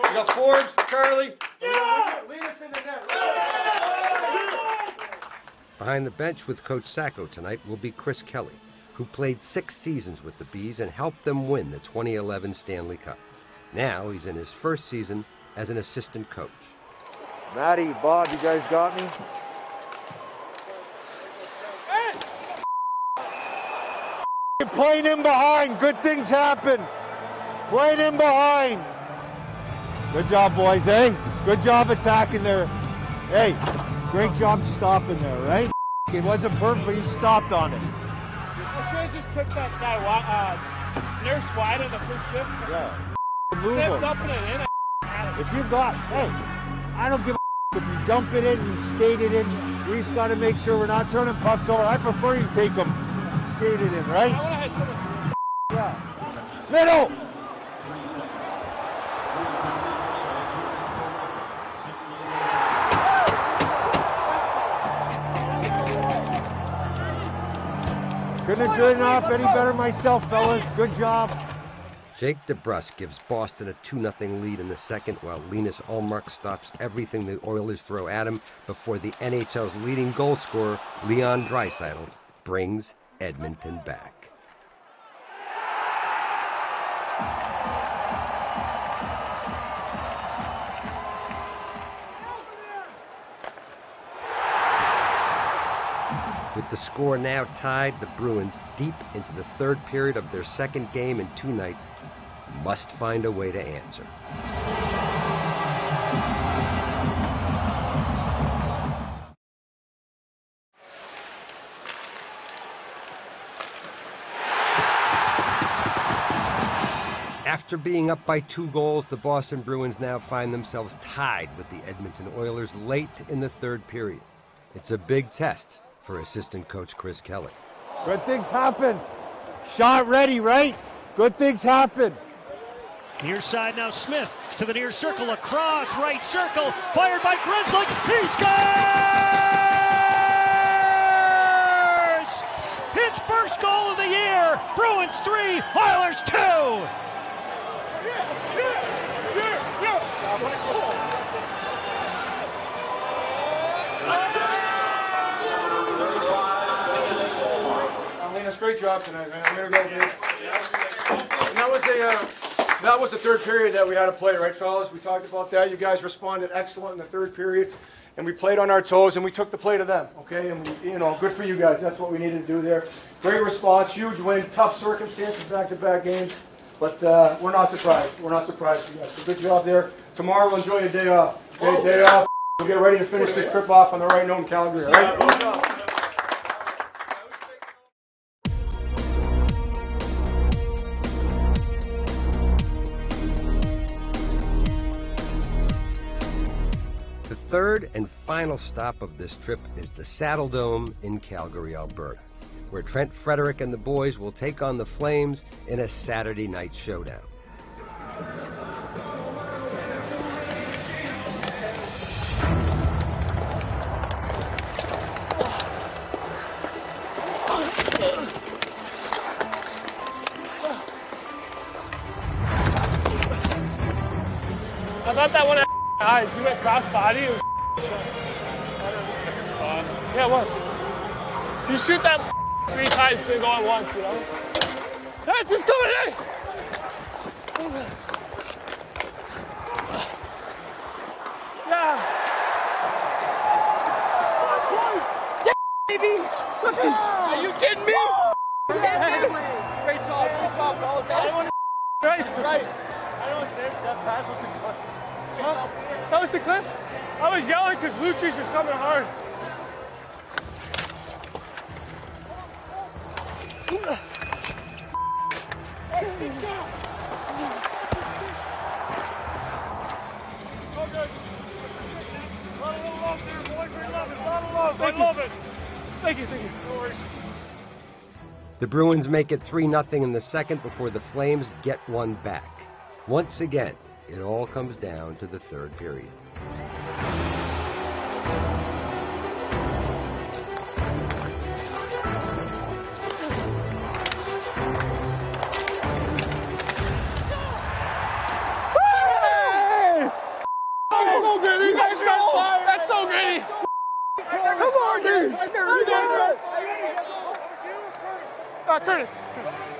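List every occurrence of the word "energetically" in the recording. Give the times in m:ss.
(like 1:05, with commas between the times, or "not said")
not said.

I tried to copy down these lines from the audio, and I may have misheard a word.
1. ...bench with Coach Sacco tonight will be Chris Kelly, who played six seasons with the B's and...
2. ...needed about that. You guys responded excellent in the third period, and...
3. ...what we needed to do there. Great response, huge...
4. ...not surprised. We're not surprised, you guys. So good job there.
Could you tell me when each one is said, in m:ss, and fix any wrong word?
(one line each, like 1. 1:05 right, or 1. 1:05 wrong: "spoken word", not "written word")
1. 0:06 right
2. 2:44 wrong: "talked", not "needed"
3. 2:51 right
4. 2:57 right.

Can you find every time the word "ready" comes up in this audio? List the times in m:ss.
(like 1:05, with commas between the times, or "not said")
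2:10, 3:02.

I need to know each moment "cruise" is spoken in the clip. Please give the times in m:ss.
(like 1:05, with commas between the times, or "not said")
not said.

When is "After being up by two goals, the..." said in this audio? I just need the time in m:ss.
1:57.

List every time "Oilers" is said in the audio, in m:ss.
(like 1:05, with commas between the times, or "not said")
1:17, 2:02, 2:25.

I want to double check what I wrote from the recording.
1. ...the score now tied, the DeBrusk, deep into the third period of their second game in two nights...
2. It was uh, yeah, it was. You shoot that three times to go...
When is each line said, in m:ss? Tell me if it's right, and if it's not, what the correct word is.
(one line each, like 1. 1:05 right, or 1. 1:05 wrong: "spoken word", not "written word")
1. 1:36 wrong: "Bruins", not "DeBrusk"
2. 3:46 right.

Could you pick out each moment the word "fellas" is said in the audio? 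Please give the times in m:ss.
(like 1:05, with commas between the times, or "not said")
1:10, 2:44.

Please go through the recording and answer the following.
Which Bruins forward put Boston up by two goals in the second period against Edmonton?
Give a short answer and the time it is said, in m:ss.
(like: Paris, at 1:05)
Jake DeBrusk, at 1:12.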